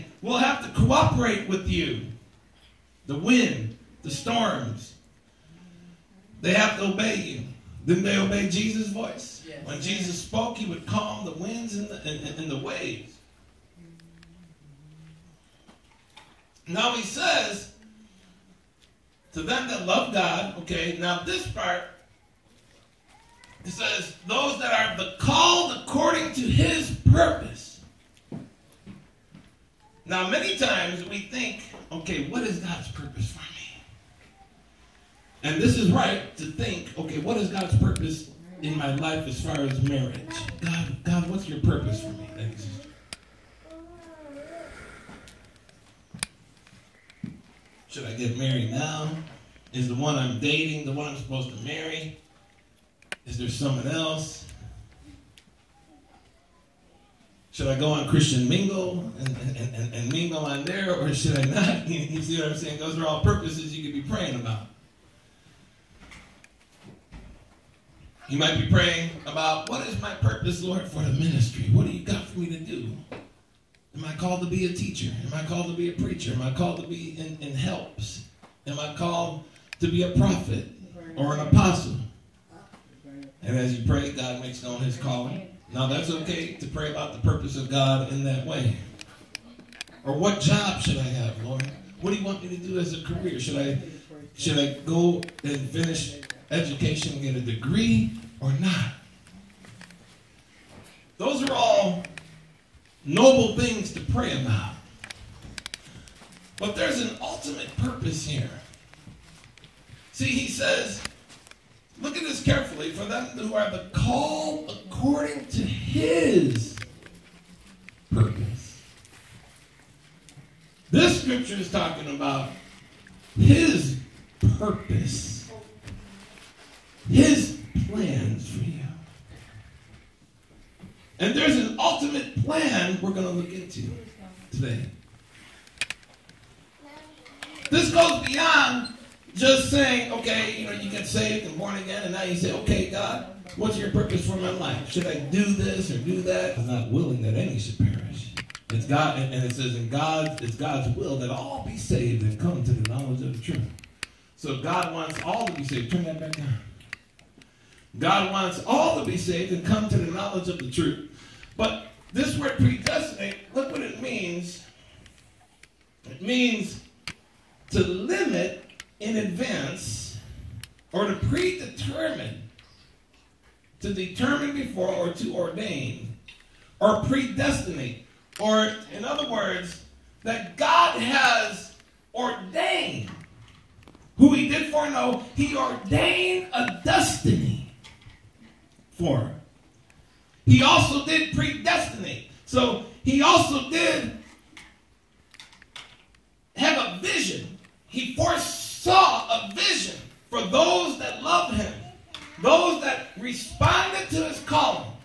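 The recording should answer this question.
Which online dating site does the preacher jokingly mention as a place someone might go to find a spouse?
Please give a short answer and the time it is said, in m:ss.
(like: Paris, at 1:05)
Christian Mingle, at 0:58.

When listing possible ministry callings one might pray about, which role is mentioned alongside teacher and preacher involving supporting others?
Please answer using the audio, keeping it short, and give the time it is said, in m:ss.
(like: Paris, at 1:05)
helps, at 1:17.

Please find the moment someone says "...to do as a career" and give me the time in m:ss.
1:32.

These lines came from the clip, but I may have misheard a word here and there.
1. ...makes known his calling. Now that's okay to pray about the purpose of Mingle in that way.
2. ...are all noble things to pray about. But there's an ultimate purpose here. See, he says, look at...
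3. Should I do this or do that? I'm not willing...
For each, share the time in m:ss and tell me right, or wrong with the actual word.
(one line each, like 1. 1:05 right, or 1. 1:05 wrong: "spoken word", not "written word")
1. 1:24 wrong: "God", not "Mingle"
2. 1:41 right
3. 2:24 right.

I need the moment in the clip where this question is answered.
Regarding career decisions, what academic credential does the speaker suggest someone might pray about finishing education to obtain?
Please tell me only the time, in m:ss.
1:37.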